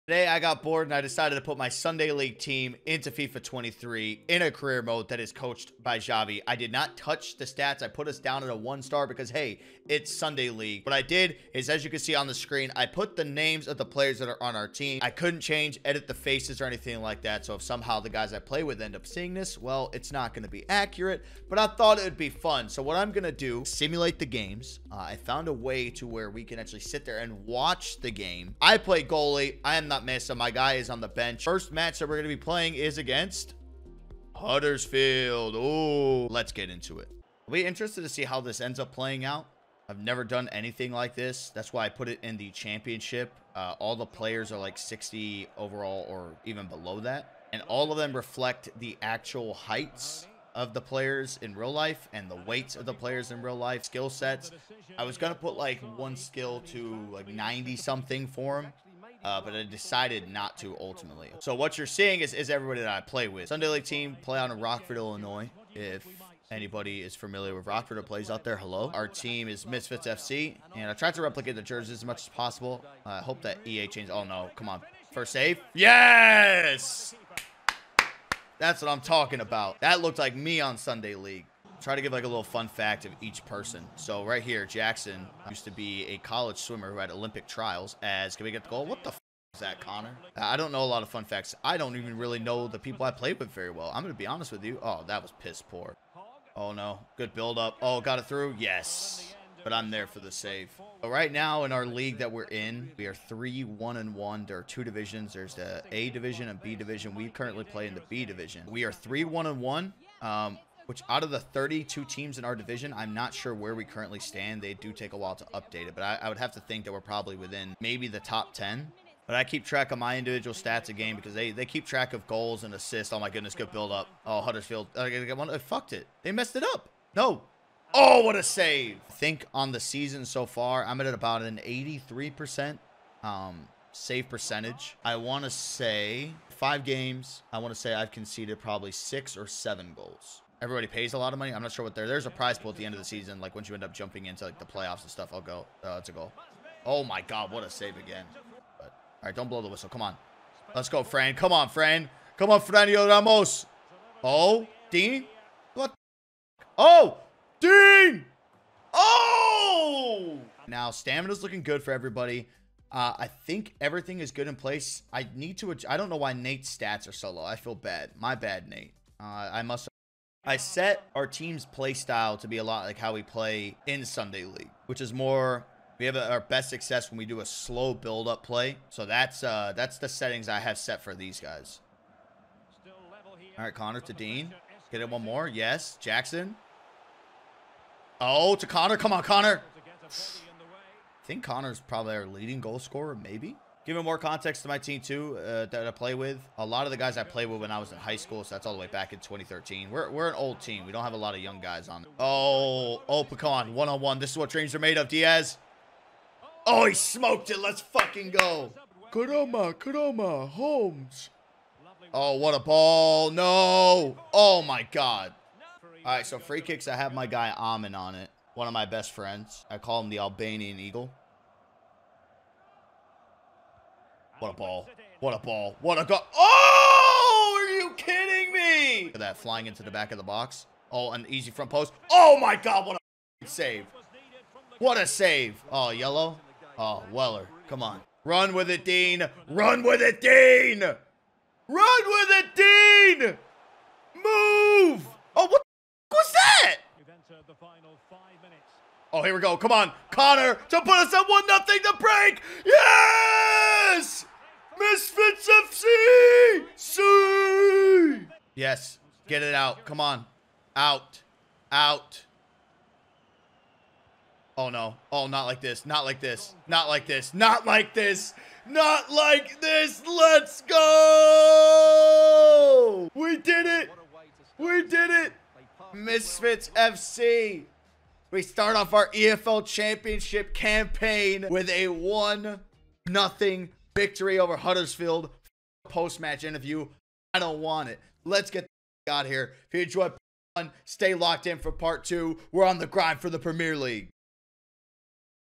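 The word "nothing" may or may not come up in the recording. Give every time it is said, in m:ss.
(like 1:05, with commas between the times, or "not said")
4:11, 4:43.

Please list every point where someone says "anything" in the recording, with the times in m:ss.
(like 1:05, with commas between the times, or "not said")
0:16, 0:40.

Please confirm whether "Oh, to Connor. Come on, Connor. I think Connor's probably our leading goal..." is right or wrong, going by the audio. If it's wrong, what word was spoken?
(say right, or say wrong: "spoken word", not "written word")
right.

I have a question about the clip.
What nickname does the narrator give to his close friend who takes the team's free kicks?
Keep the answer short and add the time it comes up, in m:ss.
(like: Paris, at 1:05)
the Albanian Eagle, at 3:40.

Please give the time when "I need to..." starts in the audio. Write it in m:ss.
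2:45.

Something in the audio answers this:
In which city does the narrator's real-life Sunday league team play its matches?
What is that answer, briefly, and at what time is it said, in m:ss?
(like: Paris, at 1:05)
Rockford, Illinois, at 1:04.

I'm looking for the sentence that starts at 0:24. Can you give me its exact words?
Uh, I found a way to where we can actually sit there and watch the game.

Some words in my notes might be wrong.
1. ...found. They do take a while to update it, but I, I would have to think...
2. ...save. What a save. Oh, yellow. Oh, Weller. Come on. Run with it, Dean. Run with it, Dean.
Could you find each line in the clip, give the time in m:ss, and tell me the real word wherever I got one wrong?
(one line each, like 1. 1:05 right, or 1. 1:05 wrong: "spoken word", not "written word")
1. 1:54 wrong: "stand", not "found"
2. 3:53 right.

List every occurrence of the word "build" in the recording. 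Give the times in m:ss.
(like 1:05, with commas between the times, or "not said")
1:37, 2:03, 2:57.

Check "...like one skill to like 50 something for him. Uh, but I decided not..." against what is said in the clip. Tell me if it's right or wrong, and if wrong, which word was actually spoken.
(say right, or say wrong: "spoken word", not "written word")
wrong: "90", not "50".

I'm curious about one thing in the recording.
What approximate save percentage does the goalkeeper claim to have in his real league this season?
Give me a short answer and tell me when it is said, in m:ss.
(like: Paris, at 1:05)
83%, at 2:11.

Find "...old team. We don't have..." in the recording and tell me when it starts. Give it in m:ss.
3:20.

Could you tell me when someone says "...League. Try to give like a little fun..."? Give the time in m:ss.
1:21.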